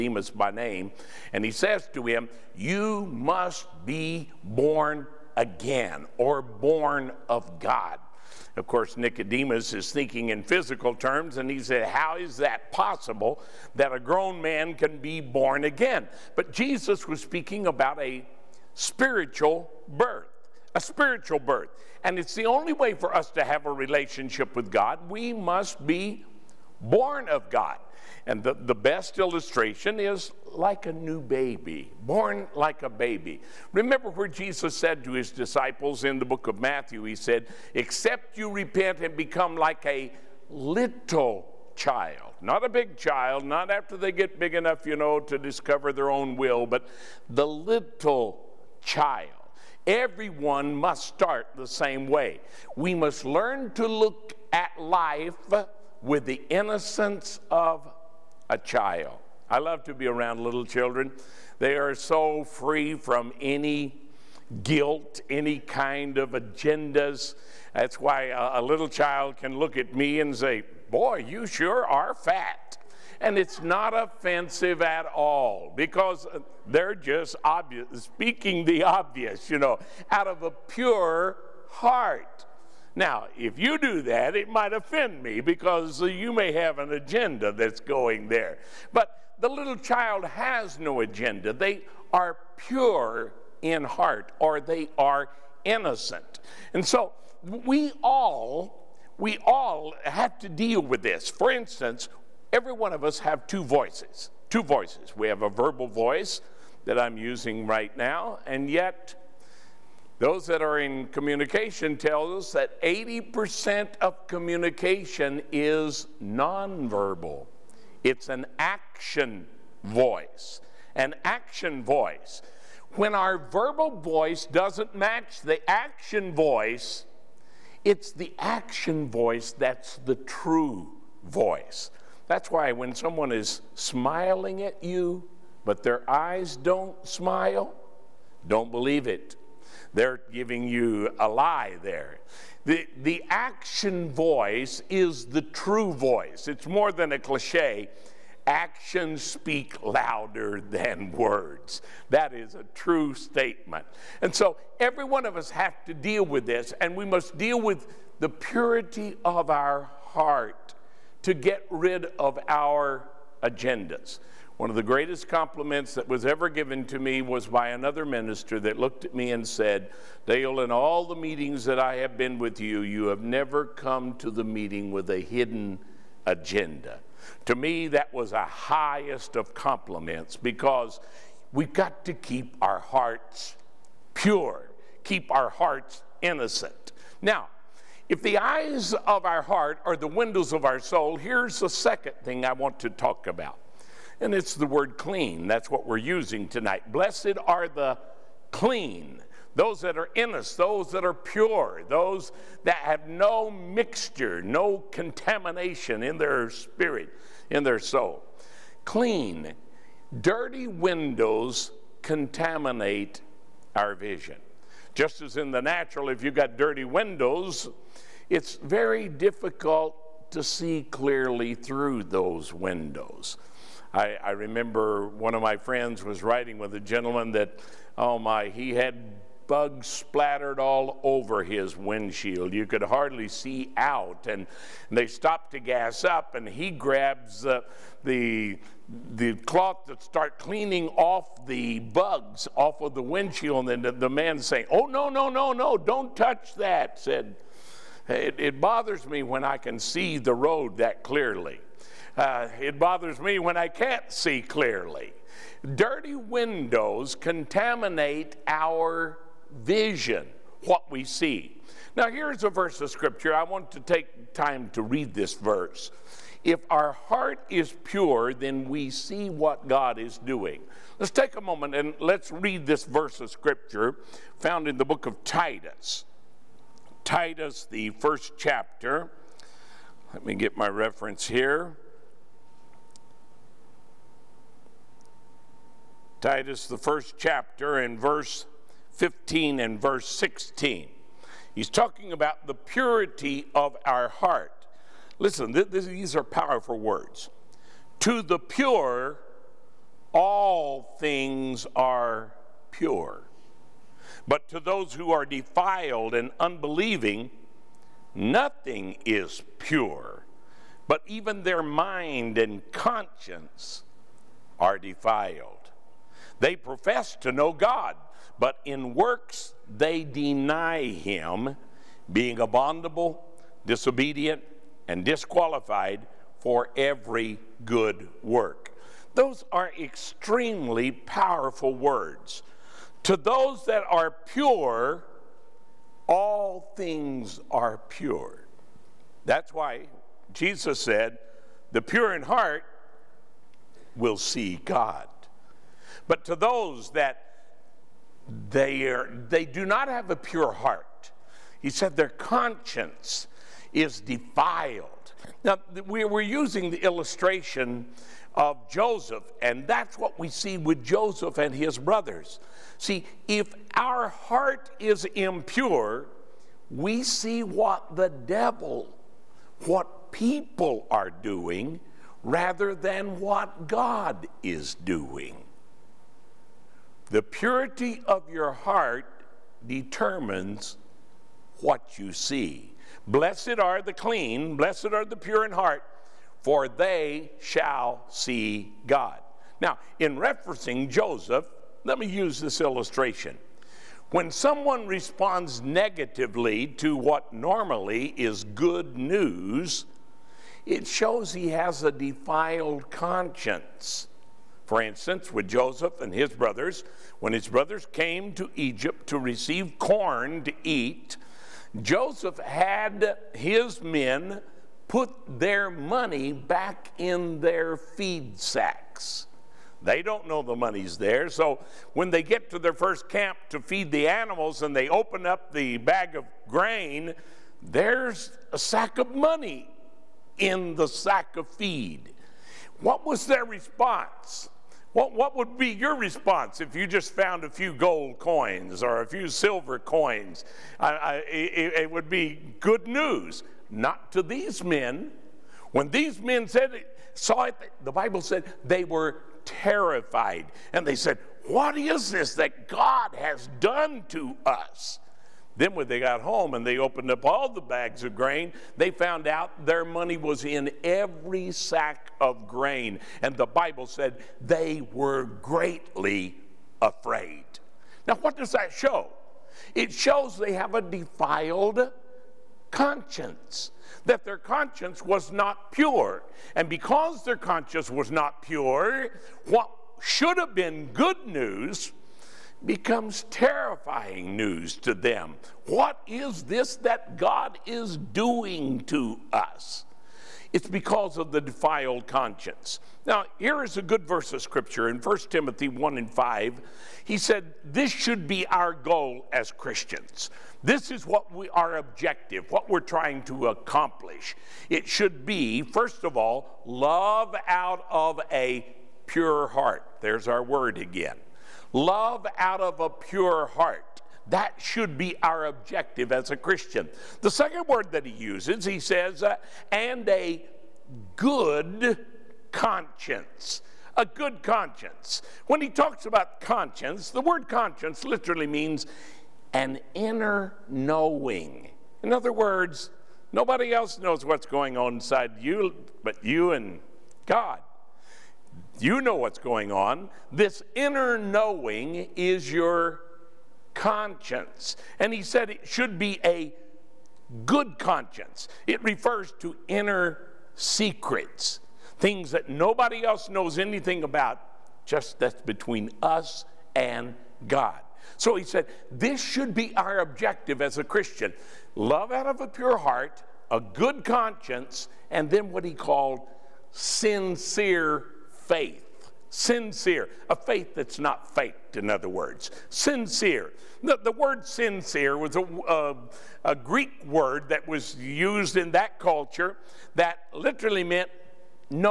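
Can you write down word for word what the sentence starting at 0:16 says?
But Jesus was speaking about a spiritual birth, a spiritual birth.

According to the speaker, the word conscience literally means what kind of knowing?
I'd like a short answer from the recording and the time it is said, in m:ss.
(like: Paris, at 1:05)
An inner knowing, at 8:49.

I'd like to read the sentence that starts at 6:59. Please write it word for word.
They don't know the money's there.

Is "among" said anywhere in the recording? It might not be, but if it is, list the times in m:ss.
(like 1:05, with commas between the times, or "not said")
not said.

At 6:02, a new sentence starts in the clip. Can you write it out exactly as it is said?
See, if our heart is impure, we see what the devil, what people are doing, rather than what God is doing.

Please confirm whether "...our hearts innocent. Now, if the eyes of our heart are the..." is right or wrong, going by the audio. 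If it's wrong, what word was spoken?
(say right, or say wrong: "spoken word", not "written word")
right.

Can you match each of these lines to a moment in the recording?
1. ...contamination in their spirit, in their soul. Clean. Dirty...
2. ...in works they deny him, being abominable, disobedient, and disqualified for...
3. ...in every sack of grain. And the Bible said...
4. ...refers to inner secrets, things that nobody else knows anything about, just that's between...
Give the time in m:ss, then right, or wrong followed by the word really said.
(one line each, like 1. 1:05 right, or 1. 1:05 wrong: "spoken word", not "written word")
1. 3:24 right
2. 5:18 right
3. 7:40 right
4. 9:08 right.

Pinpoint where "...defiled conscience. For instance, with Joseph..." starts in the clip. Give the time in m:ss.
6:41.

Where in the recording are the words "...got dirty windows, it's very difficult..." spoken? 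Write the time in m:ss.
3:36.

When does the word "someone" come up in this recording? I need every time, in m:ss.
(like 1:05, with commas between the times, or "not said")
2:12, 6:34.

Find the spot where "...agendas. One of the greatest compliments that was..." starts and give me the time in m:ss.
2:43.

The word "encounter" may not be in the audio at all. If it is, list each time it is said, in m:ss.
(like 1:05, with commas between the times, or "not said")
not said.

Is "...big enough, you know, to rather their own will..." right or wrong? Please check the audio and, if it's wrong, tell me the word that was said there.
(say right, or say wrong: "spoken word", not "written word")
wrong: "discover", not "rather".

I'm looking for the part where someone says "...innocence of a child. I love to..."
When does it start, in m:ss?
0:56.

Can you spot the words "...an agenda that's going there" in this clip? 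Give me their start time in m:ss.
1:26.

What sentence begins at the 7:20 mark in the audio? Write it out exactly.
I, I, it, it would be good news, not to these men.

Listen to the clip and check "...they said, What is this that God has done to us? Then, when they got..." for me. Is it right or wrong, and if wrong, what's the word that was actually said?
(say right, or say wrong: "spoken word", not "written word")
right.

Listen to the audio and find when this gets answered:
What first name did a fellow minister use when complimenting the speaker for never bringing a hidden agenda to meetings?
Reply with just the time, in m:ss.
2:50.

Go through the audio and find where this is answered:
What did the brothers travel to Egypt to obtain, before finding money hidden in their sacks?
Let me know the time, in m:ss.
6:49.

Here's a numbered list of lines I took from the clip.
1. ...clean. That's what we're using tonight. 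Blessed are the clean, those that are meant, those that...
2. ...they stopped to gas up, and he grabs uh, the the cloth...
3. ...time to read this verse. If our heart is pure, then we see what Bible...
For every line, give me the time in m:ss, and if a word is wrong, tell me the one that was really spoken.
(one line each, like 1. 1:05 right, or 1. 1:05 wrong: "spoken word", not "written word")
1. 3:14 wrong: "innocent", not "meant"
2. 3:54 right
3. 4:24 wrong: "God", not "Bible".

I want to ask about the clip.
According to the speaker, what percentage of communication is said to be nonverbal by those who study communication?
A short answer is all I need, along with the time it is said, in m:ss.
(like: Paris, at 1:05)
80%, at 1:52.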